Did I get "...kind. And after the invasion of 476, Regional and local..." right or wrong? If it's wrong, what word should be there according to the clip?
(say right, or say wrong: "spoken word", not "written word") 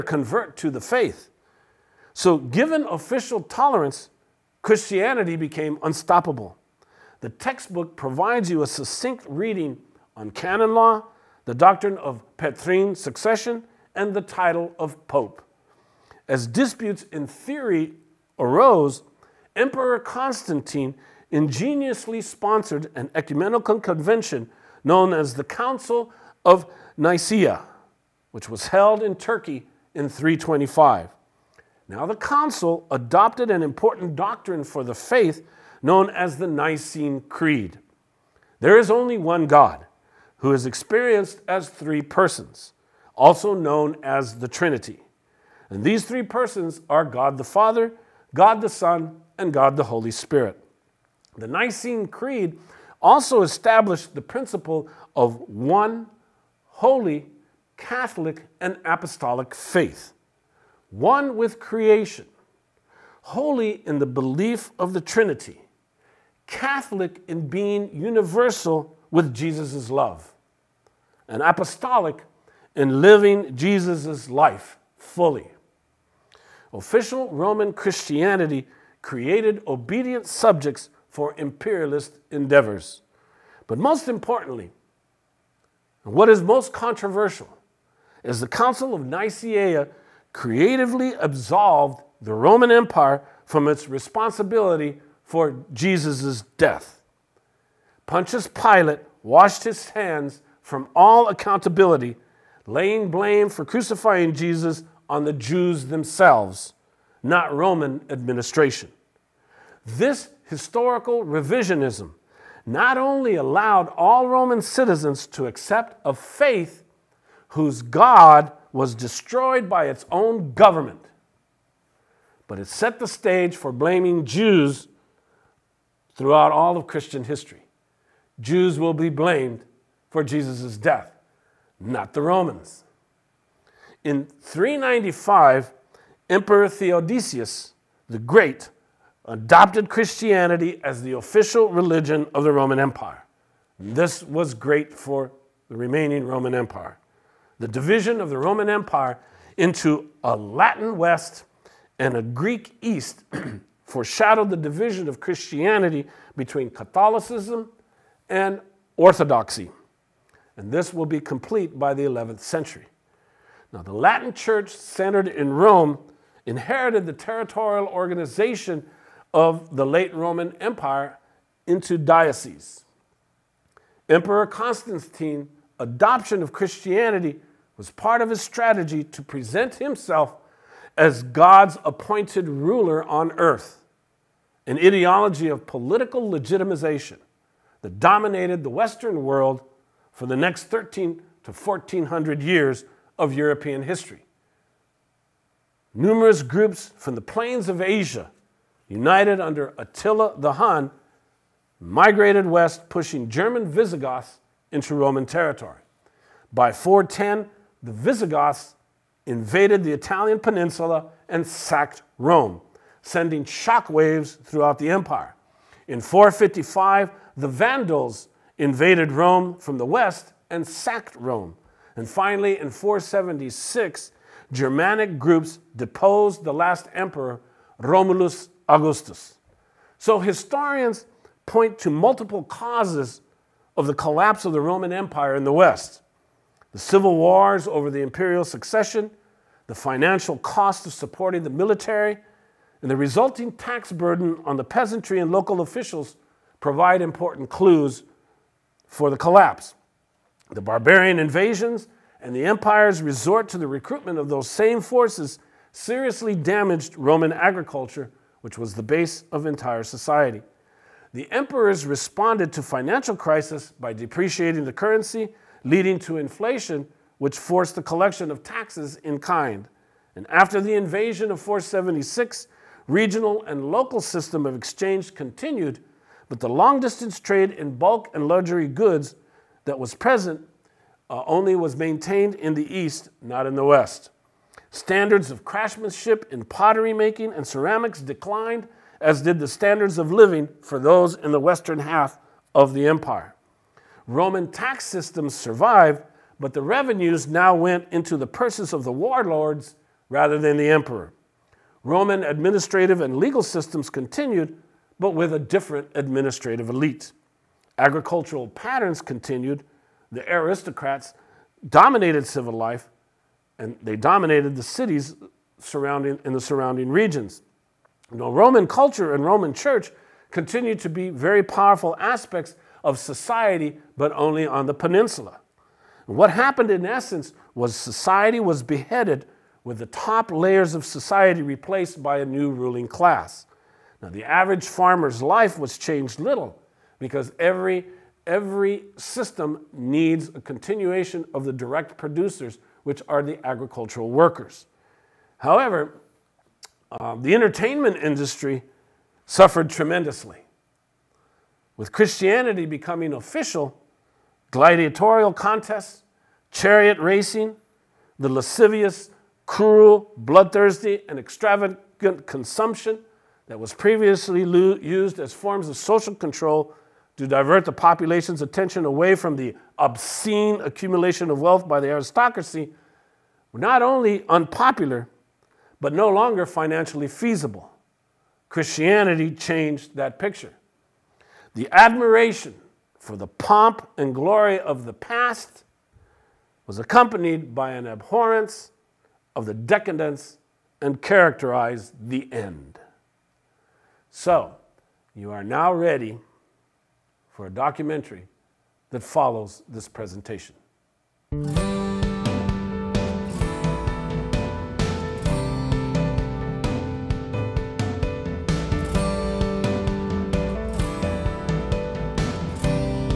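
right.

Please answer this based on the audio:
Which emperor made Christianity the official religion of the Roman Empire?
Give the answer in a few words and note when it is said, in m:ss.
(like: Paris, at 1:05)
Theodosius the Great, at 2:16.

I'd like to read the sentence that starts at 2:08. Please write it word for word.
Jews will be blamed for Jesus' death, not the Romans.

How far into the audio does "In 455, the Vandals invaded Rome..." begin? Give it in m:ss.
3:35.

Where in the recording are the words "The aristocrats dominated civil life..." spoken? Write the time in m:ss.
5:10.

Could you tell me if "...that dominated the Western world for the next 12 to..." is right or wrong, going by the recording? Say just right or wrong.
wrong.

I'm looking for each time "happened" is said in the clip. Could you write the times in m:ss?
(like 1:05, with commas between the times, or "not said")
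5:26.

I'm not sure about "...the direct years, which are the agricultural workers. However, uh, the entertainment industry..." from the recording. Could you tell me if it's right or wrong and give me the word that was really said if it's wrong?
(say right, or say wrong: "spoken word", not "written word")
wrong: "producers", not "years".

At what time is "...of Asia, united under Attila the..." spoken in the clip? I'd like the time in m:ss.
3:17.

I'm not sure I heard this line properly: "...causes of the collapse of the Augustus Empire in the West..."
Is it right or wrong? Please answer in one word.
wrong.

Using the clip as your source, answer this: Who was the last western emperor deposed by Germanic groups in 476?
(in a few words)
Romulus Augustus.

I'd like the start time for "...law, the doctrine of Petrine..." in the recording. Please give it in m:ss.
0:10.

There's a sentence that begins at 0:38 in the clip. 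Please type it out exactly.
There is only one God who is experienced as three persons, also known as the Trinity.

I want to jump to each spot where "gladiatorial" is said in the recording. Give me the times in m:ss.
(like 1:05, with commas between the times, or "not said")
5:54.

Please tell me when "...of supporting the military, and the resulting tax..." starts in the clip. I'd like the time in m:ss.
4:00.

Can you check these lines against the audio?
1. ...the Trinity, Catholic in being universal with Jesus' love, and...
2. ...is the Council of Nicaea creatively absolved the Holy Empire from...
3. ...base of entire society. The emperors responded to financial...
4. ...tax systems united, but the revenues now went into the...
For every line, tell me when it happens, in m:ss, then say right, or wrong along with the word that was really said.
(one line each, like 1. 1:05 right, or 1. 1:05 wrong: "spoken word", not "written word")
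1. 1:04 right
2. 1:28 wrong: "Roman", not "Holy"
3. 4:18 right
4. 4:54 wrong: "survived", not "united".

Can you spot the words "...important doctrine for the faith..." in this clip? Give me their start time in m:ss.
0:33.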